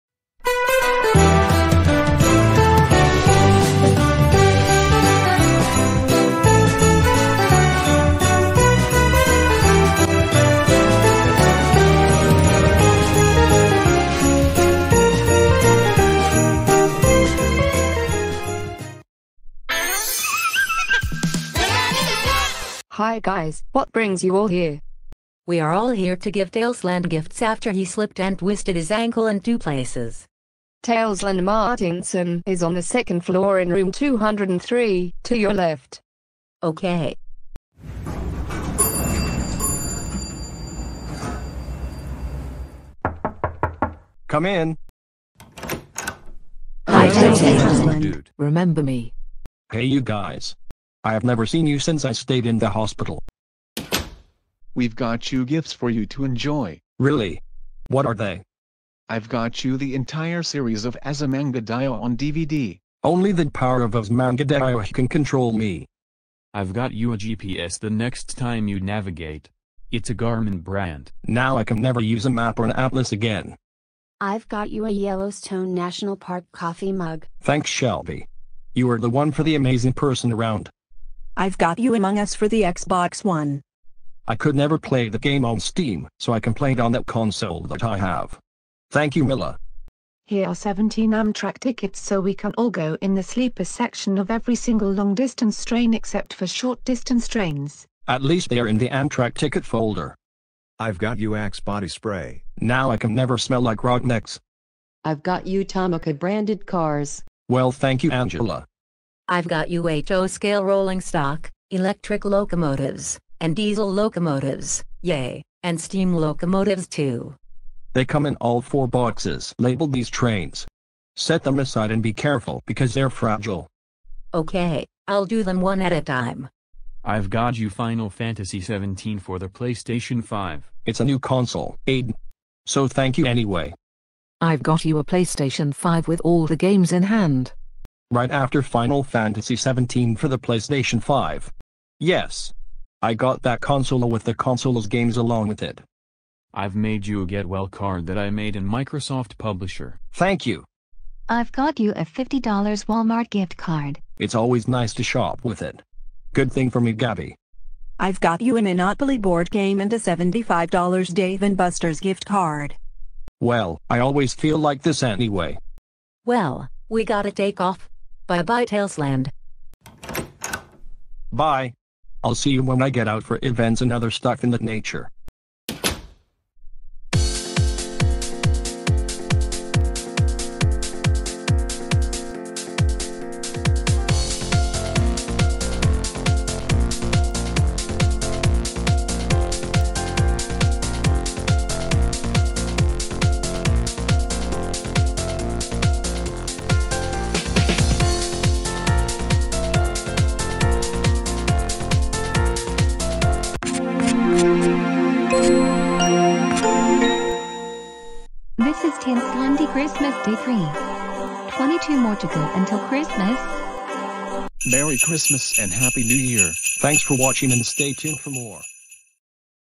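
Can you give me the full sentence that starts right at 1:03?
Only the power of Azumanga Daioh can control me.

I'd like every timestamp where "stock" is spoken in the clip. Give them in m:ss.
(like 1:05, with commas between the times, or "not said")
1:51.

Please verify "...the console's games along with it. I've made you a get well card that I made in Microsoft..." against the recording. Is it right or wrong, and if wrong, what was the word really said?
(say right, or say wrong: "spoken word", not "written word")
right.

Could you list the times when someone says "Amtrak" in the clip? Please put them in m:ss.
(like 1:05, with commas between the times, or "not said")
1:31, 1:38.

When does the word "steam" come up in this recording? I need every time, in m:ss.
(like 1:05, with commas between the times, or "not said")
1:25, 1:55.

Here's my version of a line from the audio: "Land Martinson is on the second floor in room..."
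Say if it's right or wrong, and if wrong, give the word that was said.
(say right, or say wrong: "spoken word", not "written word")
right.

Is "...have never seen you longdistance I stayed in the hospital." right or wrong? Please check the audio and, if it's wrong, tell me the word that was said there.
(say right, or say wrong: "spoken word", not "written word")
wrong: "since", not "longdistance".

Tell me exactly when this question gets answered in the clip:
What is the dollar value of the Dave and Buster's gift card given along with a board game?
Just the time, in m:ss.
2:39.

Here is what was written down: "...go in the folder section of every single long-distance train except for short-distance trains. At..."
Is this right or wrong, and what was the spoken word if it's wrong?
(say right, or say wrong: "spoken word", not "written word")
wrong: "sleeper", not "folder".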